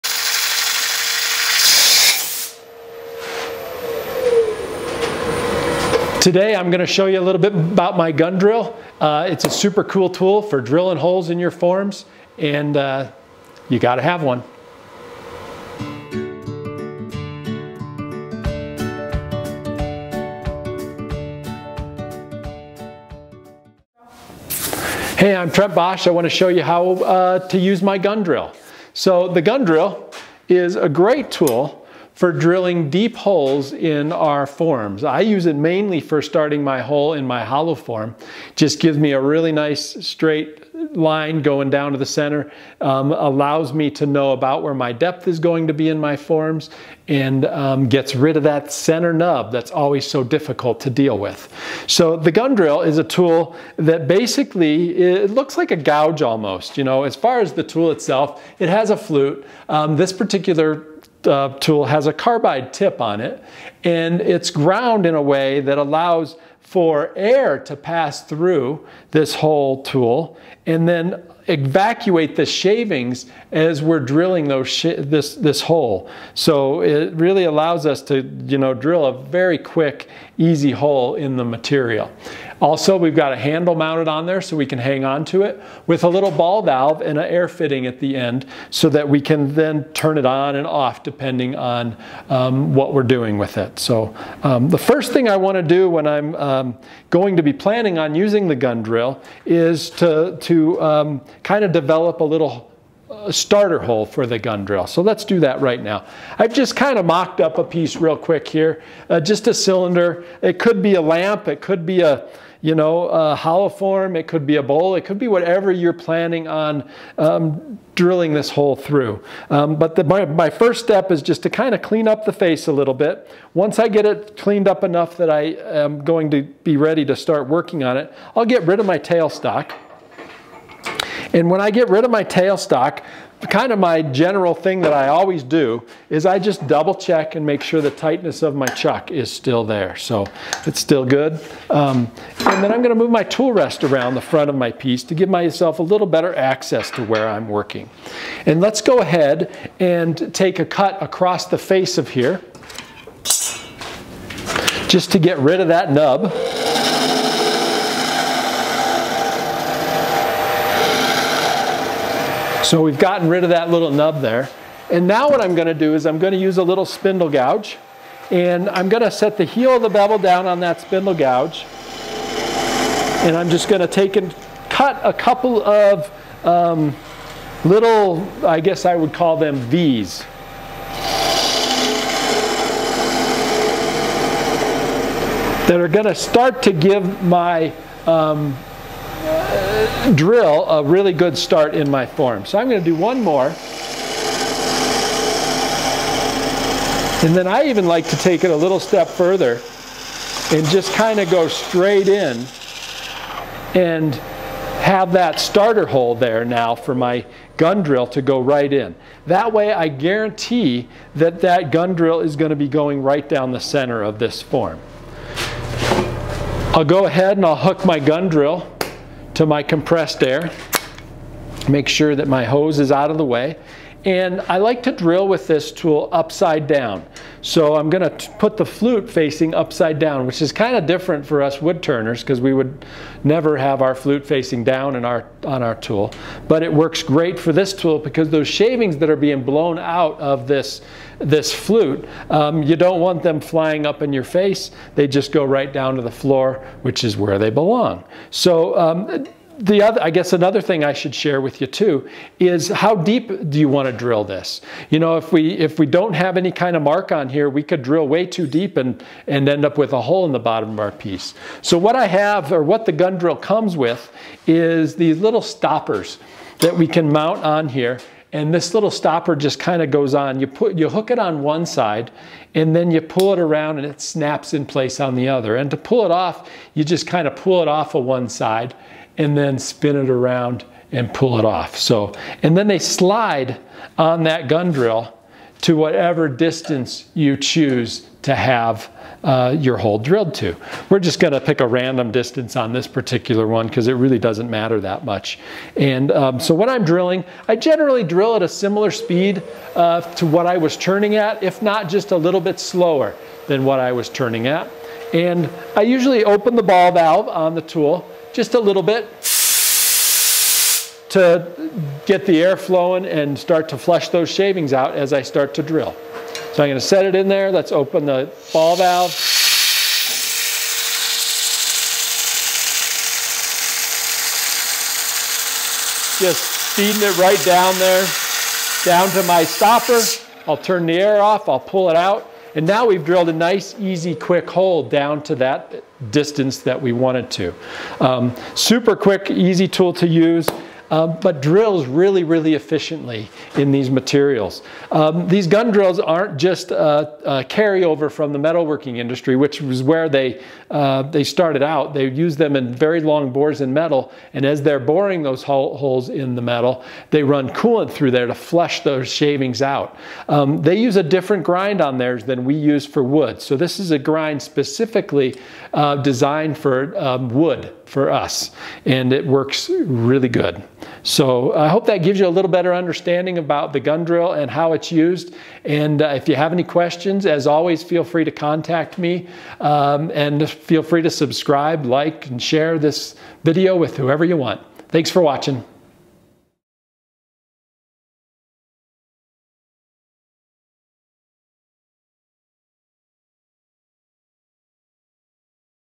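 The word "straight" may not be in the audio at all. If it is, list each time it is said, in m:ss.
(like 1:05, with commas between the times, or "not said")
0:40, 3:21.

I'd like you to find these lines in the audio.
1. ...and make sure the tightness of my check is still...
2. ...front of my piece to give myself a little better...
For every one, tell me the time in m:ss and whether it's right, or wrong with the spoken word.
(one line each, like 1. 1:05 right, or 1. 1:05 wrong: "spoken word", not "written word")
1. 2:17 wrong: "chuck", not "check"
2. 2:24 right.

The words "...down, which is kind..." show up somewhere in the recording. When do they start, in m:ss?
3:49.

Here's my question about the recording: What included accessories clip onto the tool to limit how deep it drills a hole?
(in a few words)
stoppers.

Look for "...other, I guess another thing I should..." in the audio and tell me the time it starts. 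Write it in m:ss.
4:09.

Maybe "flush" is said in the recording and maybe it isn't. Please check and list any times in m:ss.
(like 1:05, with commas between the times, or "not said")
5:13, 5:58.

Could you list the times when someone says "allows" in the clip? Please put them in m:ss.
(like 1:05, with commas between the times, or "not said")
0:43, 1:05, 1:17.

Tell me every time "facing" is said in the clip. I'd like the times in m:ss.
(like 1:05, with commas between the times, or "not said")
3:49, 3:54.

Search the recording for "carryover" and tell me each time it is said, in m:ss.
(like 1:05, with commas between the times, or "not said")
5:47.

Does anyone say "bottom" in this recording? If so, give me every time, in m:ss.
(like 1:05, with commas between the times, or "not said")
4:20.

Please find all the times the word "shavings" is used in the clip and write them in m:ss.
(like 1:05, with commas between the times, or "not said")
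1:12, 3:58, 5:14, 5:59.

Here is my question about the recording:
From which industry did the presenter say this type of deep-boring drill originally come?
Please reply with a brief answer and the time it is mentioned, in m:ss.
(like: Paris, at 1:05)
metalworking industry, at 5:48.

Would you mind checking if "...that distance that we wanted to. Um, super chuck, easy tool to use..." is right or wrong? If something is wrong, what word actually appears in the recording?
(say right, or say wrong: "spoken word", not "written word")
wrong: "quick", not "chuck".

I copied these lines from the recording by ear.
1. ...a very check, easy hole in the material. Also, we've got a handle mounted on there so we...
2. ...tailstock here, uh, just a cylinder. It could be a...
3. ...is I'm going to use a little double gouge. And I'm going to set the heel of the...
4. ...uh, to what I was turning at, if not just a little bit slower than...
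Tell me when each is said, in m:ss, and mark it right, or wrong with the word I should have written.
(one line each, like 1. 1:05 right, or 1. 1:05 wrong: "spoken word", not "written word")
1. 1:19 wrong: "quick", not "check"
2. 1:48 wrong: "quick", not "tailstock"
3. 2:45 wrong: "spindle", not "double"
4. 4:59 right.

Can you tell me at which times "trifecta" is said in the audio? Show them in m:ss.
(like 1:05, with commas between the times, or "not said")
not said.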